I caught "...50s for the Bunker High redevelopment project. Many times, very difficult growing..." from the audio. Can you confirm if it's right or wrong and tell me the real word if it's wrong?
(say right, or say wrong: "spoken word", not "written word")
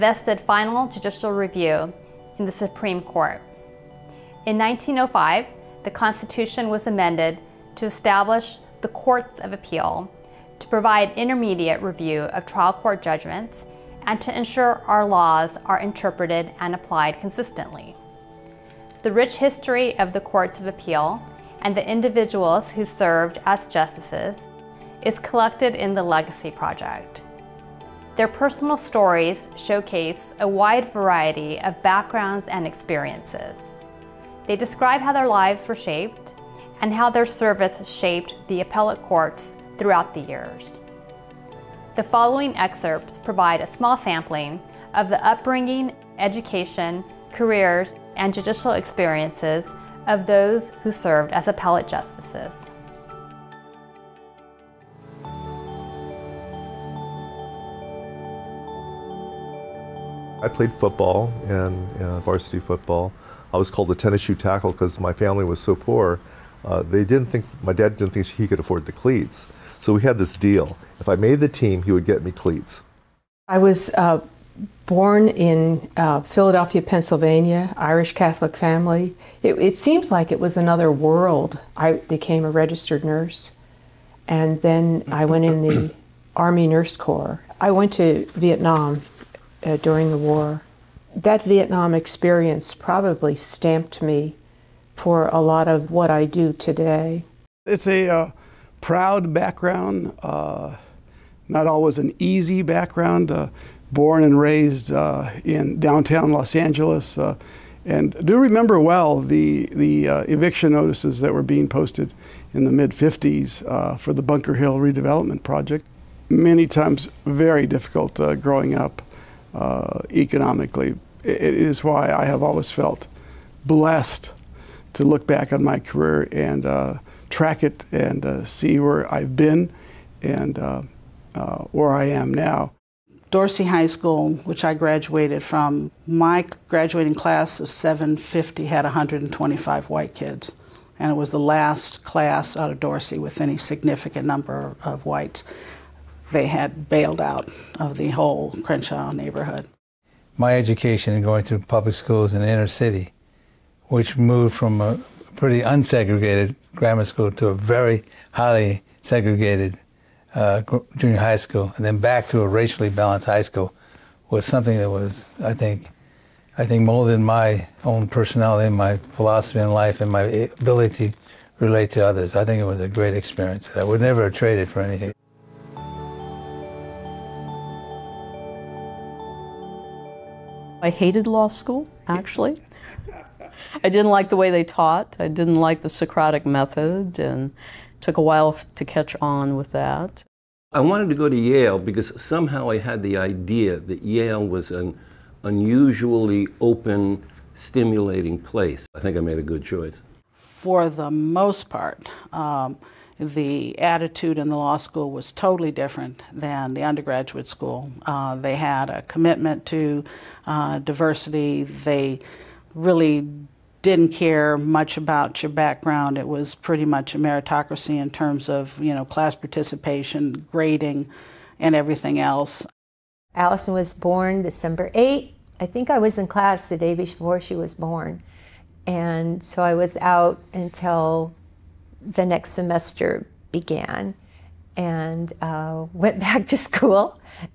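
wrong: "Hill", not "High".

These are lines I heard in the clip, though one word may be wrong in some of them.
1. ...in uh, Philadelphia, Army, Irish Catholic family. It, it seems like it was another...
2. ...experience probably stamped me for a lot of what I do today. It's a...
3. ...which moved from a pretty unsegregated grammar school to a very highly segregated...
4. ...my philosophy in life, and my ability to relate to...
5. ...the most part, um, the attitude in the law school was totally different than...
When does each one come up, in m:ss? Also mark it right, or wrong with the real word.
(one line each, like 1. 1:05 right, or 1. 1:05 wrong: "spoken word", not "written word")
1. 1:15 wrong: "Pennsylvania", not "Army"
2. 1:31 right
3. 2:33 right
4. 2:48 right
5. 3:20 right.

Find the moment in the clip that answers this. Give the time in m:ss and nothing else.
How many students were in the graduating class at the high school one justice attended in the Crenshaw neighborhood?
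2:17.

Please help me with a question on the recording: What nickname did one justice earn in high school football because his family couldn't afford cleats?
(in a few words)
tennis shoe tackle.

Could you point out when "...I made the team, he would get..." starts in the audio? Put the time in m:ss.
1:11.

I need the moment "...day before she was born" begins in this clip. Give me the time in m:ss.
3:46.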